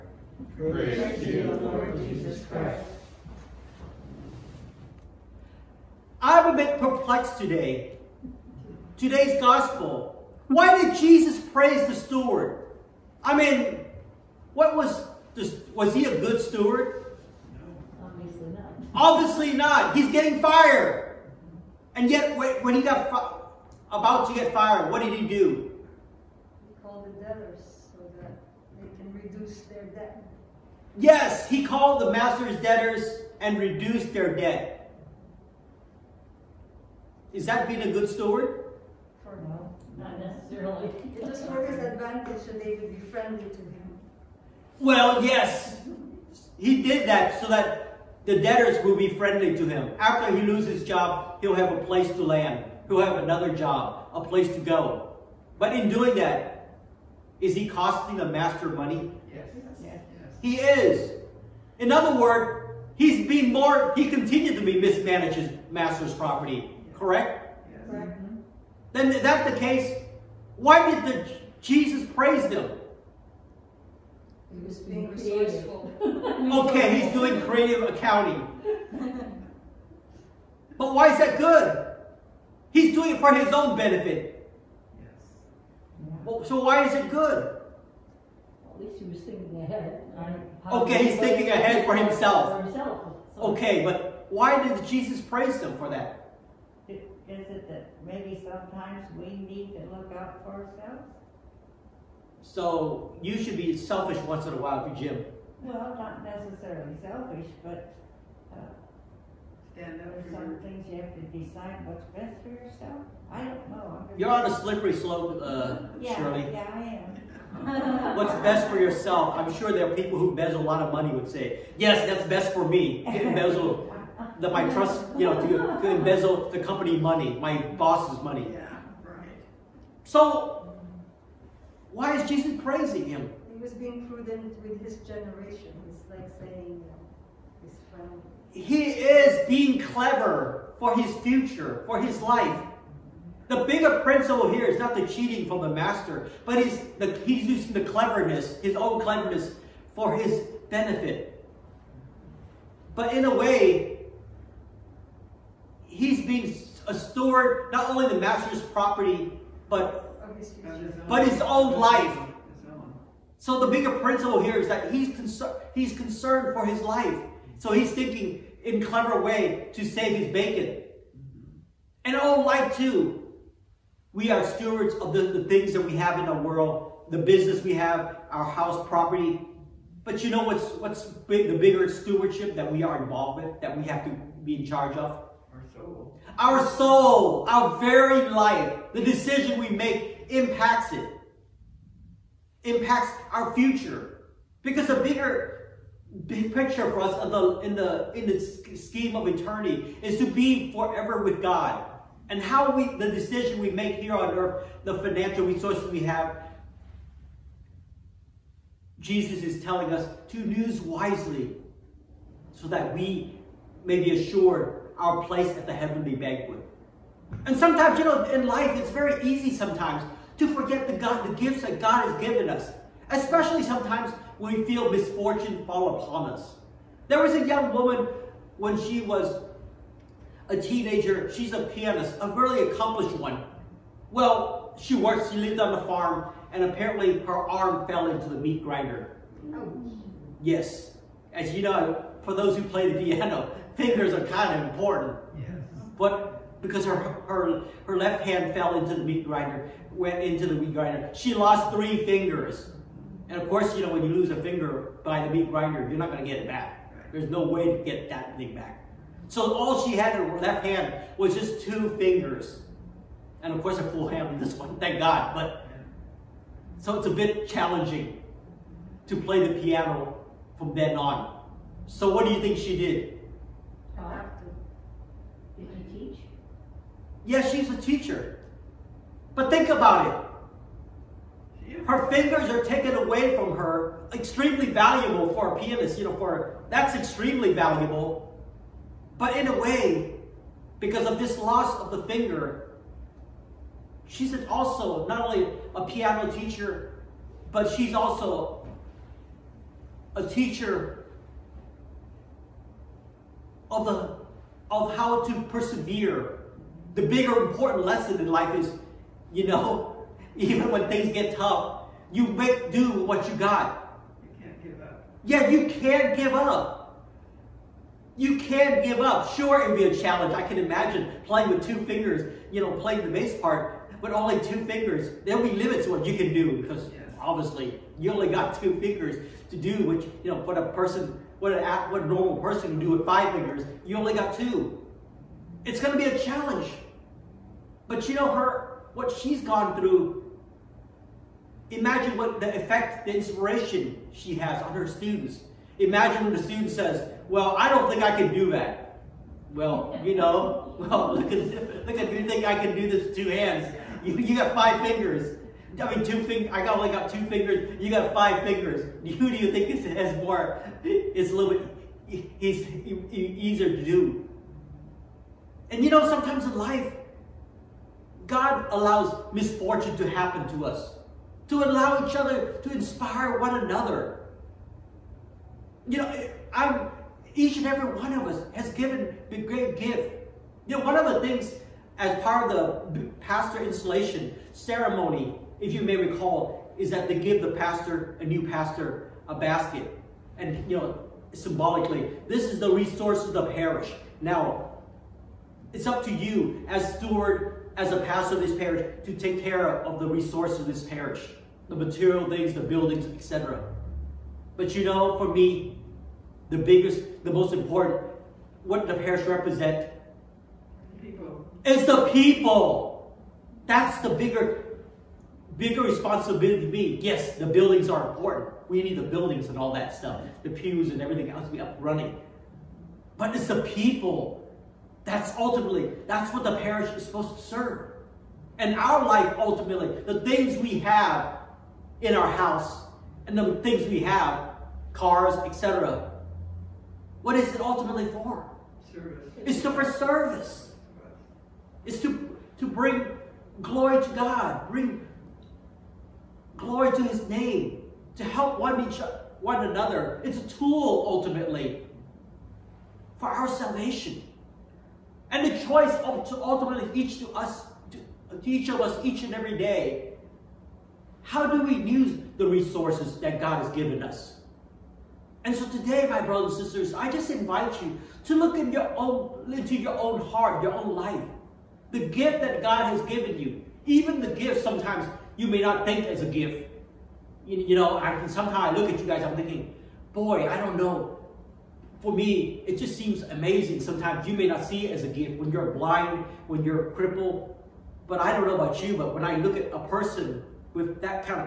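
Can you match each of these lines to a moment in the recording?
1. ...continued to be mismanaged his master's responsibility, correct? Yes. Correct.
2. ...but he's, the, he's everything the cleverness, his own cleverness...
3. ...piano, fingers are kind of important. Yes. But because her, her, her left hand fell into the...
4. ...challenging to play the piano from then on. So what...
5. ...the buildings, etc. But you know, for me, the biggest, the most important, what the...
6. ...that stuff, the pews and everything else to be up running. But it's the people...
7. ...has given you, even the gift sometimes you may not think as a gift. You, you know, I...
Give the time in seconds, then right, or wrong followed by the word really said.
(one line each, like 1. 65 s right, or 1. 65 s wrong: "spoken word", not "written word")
1. 64 s wrong: "property", not "responsibility"
2. 146 s wrong: "using", not "everything"
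3. 243 s right
4. 267 s right
5. 402 s right
6. 419 s right
7. 472 s right.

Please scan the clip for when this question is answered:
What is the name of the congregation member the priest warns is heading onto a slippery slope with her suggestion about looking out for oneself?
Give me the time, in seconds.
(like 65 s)
116 s.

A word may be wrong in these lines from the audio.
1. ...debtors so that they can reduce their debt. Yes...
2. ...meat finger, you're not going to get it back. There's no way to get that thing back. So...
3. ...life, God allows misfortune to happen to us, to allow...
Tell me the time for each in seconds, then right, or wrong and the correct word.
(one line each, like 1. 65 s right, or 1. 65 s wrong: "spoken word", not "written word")
1. 27 s right
2. 255 s wrong: "grinder", not "finger"
3. 366 s right.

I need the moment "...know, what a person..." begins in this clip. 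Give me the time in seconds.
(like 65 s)
330 s.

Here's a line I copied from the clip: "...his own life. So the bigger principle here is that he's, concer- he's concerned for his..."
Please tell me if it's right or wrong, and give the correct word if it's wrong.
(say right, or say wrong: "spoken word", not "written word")
right.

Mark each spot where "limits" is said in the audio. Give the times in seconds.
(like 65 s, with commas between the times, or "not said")
325 s.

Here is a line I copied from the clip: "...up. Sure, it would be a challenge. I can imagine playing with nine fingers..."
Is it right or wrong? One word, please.
wrong.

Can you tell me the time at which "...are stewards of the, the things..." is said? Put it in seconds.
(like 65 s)
174 s.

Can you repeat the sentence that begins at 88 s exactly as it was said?
At least he was thinking ahead.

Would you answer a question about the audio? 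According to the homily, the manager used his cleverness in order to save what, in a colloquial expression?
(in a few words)
his bacon.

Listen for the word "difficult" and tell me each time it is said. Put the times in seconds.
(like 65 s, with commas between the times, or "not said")
not said.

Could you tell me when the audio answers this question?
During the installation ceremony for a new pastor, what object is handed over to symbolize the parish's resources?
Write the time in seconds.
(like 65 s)
389 s.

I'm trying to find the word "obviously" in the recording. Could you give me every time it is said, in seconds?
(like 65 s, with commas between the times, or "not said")
18 s, 327 s.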